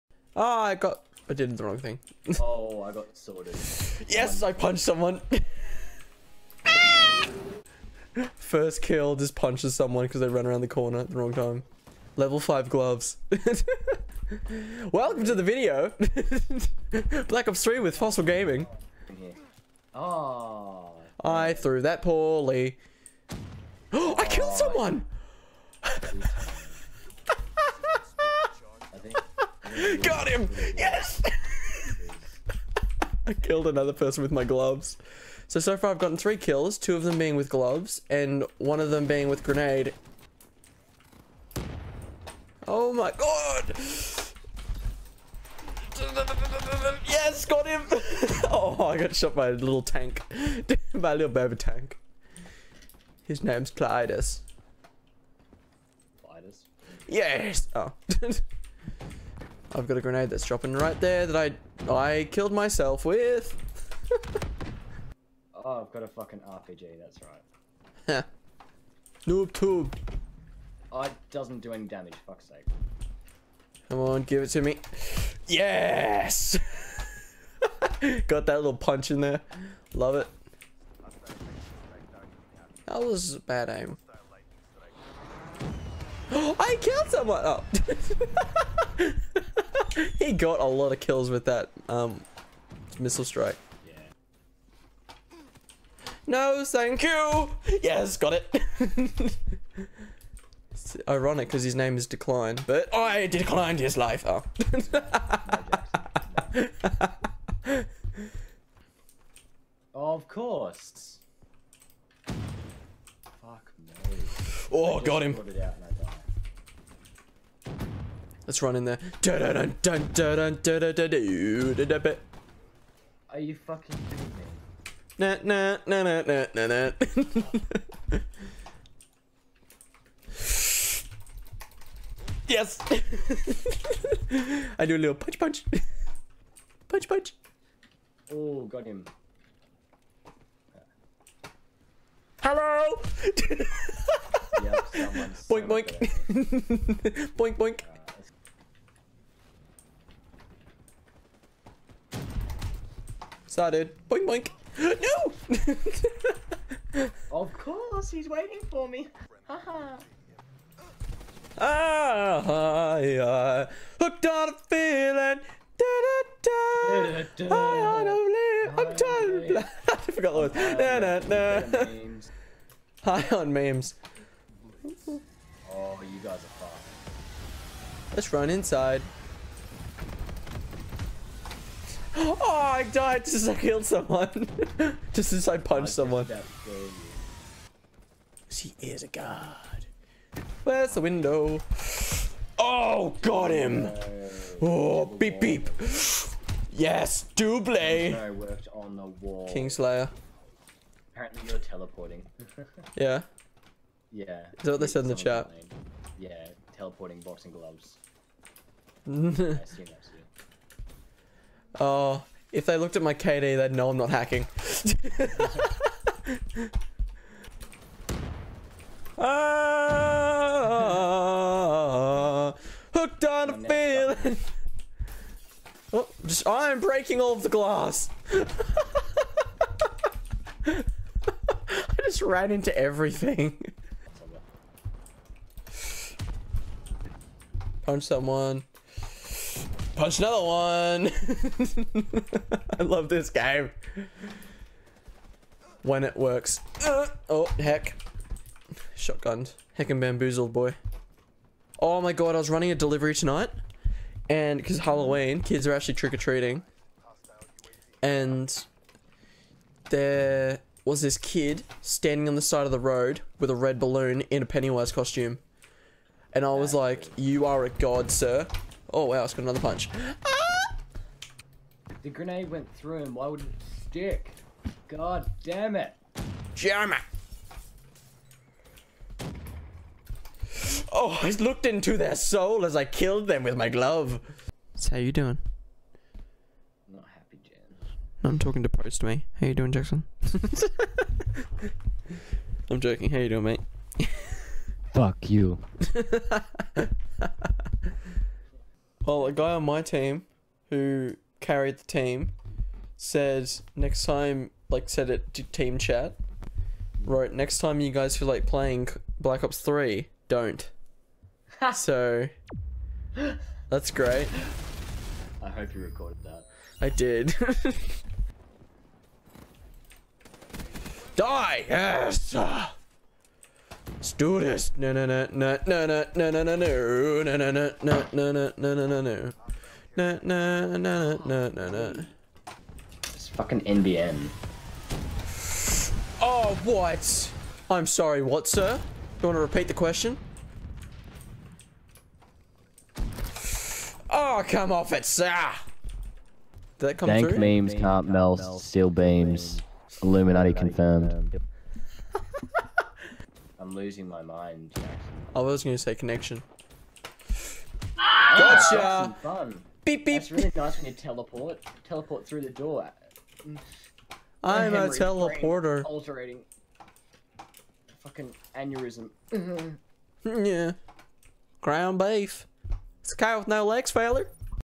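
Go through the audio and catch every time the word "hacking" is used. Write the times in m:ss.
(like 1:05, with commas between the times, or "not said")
3:34.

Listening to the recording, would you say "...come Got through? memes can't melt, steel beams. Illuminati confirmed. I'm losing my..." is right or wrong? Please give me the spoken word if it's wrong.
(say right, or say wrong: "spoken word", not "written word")
wrong: "Dank", not "Got".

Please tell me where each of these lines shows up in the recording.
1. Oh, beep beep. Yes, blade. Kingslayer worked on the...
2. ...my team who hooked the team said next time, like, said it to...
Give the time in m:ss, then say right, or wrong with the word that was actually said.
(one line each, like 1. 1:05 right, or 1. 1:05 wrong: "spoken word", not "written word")
1. 3:14 right
2. 4:59 wrong: "carried", not "hooked".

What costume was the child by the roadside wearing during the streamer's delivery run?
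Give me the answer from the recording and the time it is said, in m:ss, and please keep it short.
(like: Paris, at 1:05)
Pennywise, at 4:24.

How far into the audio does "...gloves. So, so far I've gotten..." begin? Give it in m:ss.
0:34.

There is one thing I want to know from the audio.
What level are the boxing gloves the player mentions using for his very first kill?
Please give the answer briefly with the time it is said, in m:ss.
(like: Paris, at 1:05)
Level 5, at 0:12.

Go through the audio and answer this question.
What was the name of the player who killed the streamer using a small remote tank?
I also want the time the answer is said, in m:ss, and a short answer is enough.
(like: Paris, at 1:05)
Clytus, at 0:53.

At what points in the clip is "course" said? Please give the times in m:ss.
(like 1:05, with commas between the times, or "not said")
1:50, 2:37.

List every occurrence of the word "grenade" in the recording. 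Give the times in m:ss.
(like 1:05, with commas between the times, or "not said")
0:39, 1:00, 4:32.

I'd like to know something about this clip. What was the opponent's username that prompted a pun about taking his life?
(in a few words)
Decline.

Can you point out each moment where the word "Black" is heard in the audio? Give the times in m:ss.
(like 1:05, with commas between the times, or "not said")
0:17, 5:09.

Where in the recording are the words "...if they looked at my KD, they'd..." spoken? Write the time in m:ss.
3:32.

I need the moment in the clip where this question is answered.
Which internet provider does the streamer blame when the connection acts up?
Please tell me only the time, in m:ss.
5:33.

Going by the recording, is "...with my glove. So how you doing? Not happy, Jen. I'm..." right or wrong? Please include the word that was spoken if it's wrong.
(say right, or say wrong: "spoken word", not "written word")
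right.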